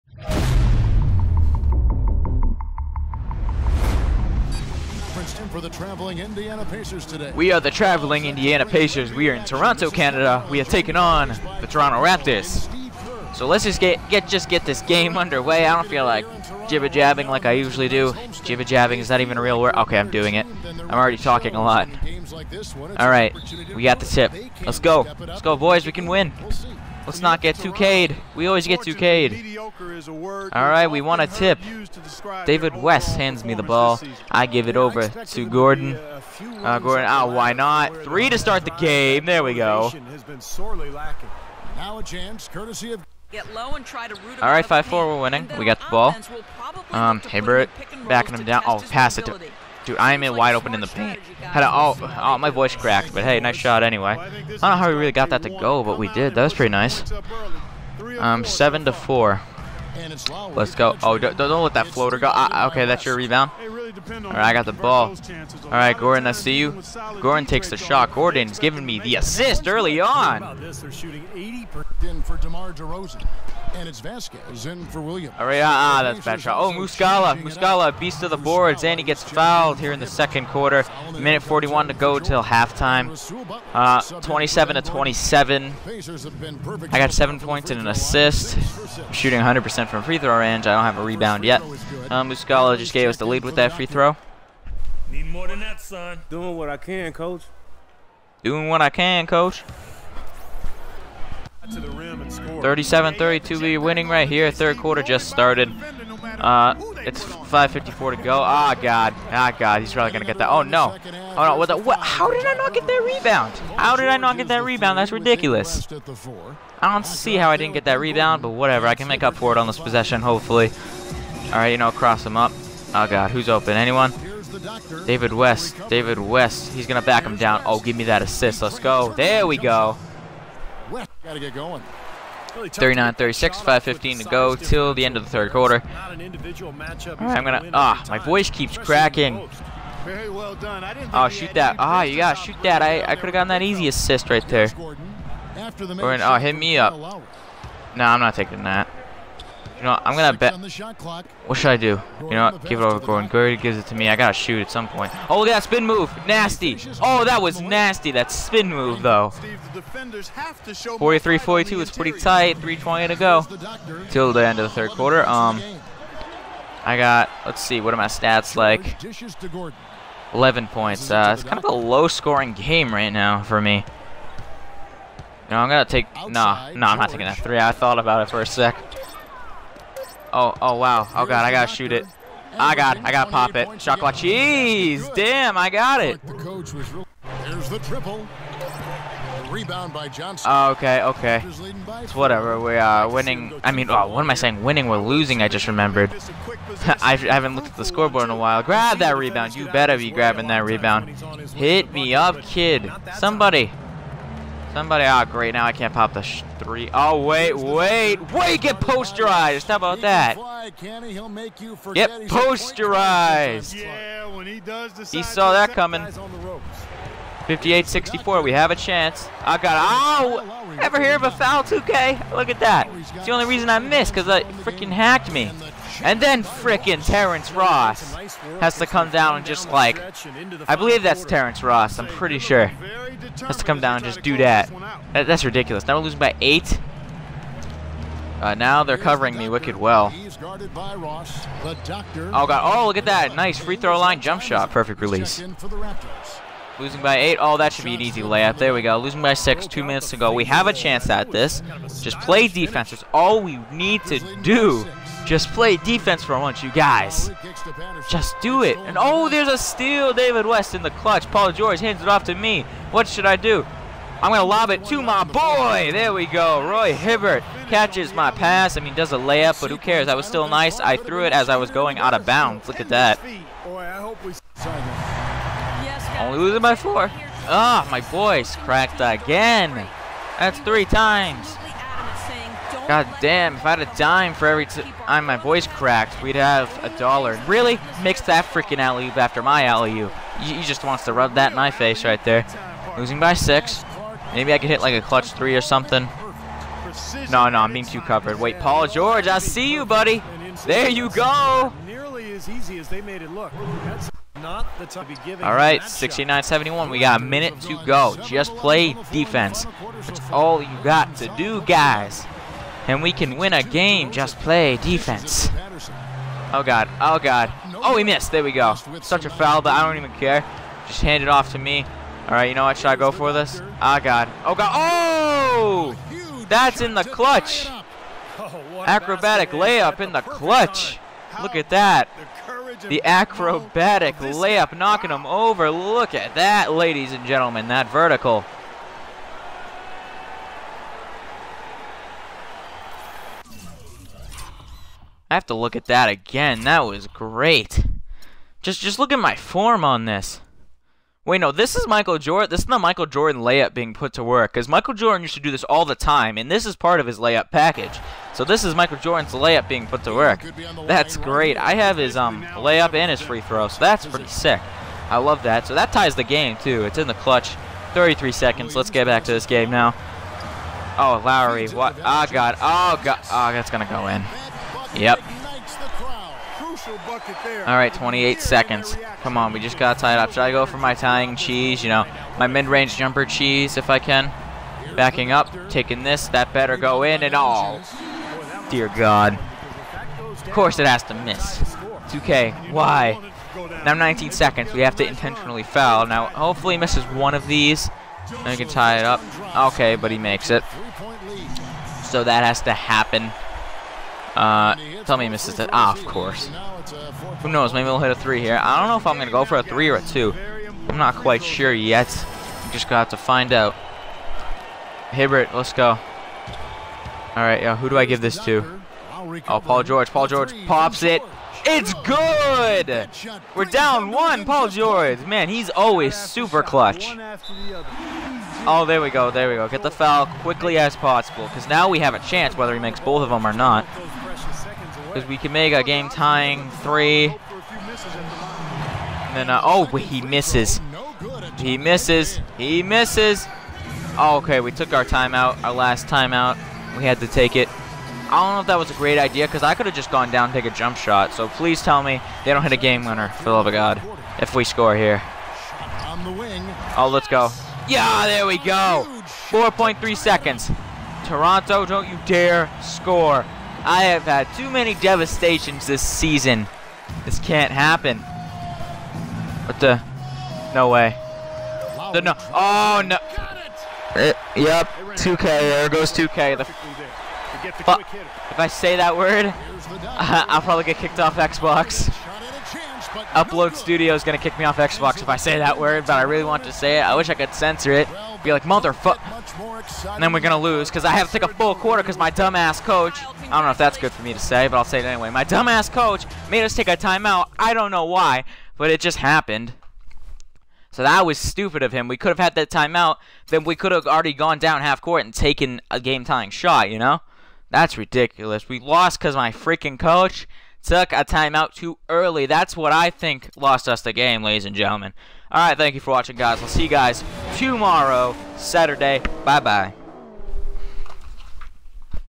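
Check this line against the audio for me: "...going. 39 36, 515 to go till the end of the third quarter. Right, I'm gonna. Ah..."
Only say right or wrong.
right.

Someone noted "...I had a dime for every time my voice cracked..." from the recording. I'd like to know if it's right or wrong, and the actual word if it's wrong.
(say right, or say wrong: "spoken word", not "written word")
right.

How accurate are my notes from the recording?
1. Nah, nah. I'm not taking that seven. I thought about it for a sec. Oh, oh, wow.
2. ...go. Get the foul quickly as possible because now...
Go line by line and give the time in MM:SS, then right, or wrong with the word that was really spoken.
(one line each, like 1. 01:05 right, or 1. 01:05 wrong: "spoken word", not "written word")
1. 02:56 wrong: "three", not "seven"
2. 07:09 right.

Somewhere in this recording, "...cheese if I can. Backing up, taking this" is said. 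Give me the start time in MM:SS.
06:23.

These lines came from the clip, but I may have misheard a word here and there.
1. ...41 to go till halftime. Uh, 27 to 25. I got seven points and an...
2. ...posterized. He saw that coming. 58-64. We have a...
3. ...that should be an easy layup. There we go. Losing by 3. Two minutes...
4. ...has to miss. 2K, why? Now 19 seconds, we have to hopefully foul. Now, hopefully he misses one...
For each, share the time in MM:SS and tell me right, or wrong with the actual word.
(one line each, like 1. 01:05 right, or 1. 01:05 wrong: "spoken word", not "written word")
1. 01:21 wrong: "27", not "25"
2. 03:32 right
3. 04:07 wrong: "6", not "3"
4. 06:30 wrong: "intentionally", not "hopefully".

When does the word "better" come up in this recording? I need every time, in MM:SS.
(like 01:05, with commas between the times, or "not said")
03:19, 06:26.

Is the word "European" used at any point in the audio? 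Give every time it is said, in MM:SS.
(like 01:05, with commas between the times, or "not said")
not said.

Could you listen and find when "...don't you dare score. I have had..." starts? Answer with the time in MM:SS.
07:41.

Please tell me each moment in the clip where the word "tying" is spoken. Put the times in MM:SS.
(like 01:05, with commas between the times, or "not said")
06:20, 07:16, 08:26.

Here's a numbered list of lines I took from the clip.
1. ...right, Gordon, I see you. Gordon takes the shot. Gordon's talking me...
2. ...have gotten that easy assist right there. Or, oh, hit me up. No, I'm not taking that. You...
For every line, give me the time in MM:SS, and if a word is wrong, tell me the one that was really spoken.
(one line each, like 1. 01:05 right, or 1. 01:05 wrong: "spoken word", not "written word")
1. 01:05 wrong: "giving", not "talking"
2. 02:23 right.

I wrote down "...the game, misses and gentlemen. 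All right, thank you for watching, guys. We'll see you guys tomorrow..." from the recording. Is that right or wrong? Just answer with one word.
wrong.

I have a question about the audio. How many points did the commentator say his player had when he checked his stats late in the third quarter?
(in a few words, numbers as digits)
11.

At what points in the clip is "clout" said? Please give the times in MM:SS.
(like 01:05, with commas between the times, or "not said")
not said.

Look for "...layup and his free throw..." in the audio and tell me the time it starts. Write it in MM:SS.
06:02.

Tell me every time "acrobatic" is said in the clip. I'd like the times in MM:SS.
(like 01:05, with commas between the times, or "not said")
05:28, 05:33.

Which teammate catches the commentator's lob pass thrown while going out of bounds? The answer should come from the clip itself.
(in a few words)
Roy Hibbert.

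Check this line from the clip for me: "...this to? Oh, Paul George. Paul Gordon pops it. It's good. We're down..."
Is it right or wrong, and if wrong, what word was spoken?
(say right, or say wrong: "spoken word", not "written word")
wrong: "George", not "Gordon".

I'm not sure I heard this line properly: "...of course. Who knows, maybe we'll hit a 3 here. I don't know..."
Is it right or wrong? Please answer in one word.
right.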